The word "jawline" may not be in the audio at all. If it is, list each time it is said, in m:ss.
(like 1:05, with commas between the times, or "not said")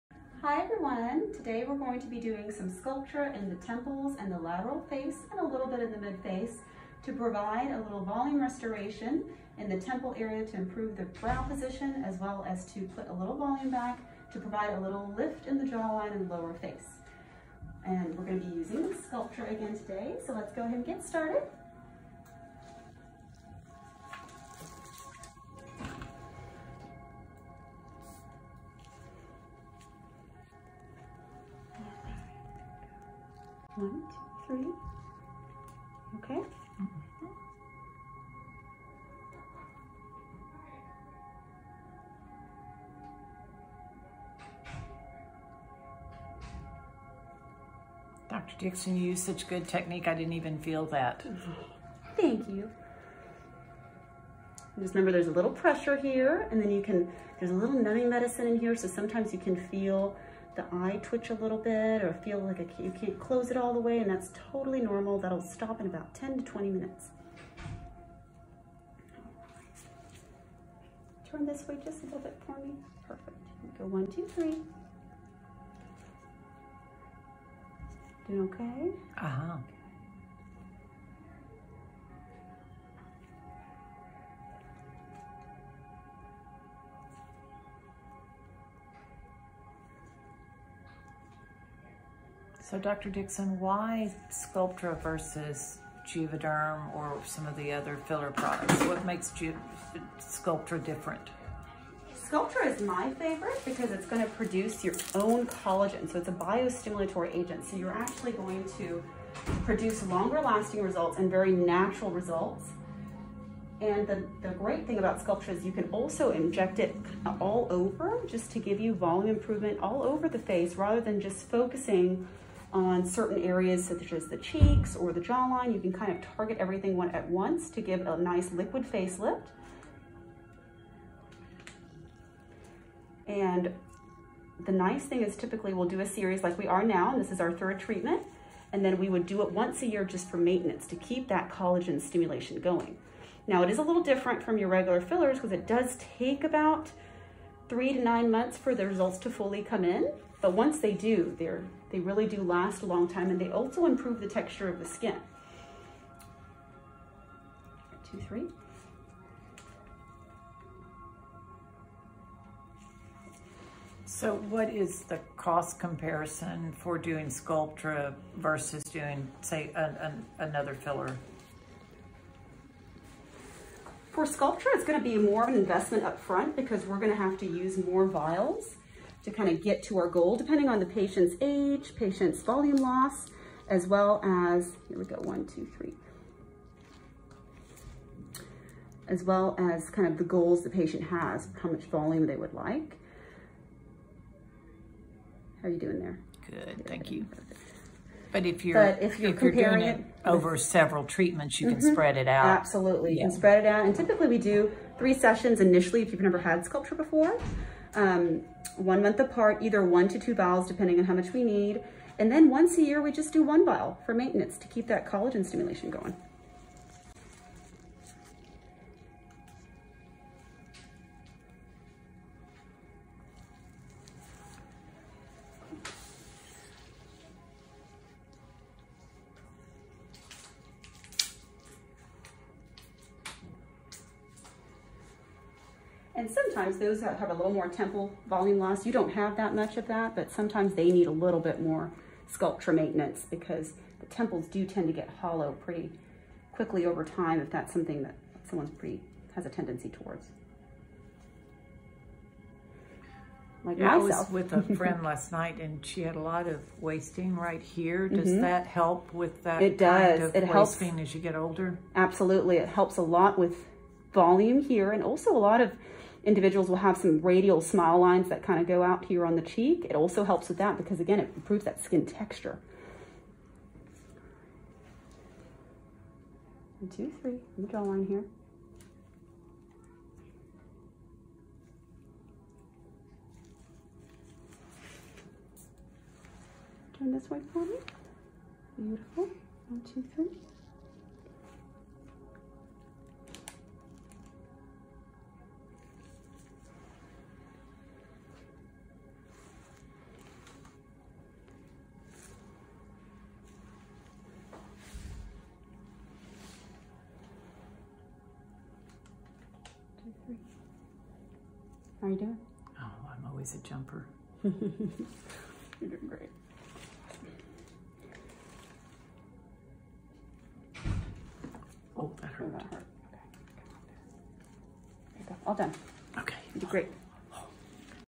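0:15, 2:05, 4:37.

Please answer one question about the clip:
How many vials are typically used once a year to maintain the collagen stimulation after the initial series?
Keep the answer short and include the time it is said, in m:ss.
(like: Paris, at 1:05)
1, at 3:33.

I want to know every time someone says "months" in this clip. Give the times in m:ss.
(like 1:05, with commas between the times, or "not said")
2:28, 3:29.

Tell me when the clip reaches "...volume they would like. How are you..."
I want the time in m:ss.
3:11.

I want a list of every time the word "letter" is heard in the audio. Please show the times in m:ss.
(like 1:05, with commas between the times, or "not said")
not said.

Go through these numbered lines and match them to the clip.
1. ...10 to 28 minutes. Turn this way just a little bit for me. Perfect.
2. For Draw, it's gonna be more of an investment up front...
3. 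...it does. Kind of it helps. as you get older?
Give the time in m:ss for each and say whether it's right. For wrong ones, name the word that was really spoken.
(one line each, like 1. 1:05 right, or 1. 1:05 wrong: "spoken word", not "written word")
1. 1:06 wrong: "20", not "28"
2. 2:54 wrong: "Sculptra", not "Draw"
3. 4:19 right.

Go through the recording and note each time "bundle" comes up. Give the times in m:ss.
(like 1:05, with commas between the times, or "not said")
not said.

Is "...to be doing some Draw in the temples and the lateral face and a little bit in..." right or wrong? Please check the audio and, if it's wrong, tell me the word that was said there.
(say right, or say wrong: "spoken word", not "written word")
wrong: "Sculptra", not "Draw".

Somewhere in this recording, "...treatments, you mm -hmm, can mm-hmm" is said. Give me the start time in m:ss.
3:21.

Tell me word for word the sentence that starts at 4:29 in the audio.
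It also helps with that because again, it improves that skin texture.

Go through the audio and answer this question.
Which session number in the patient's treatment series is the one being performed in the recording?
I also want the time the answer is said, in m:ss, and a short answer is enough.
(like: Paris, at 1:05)
third, at 2:17.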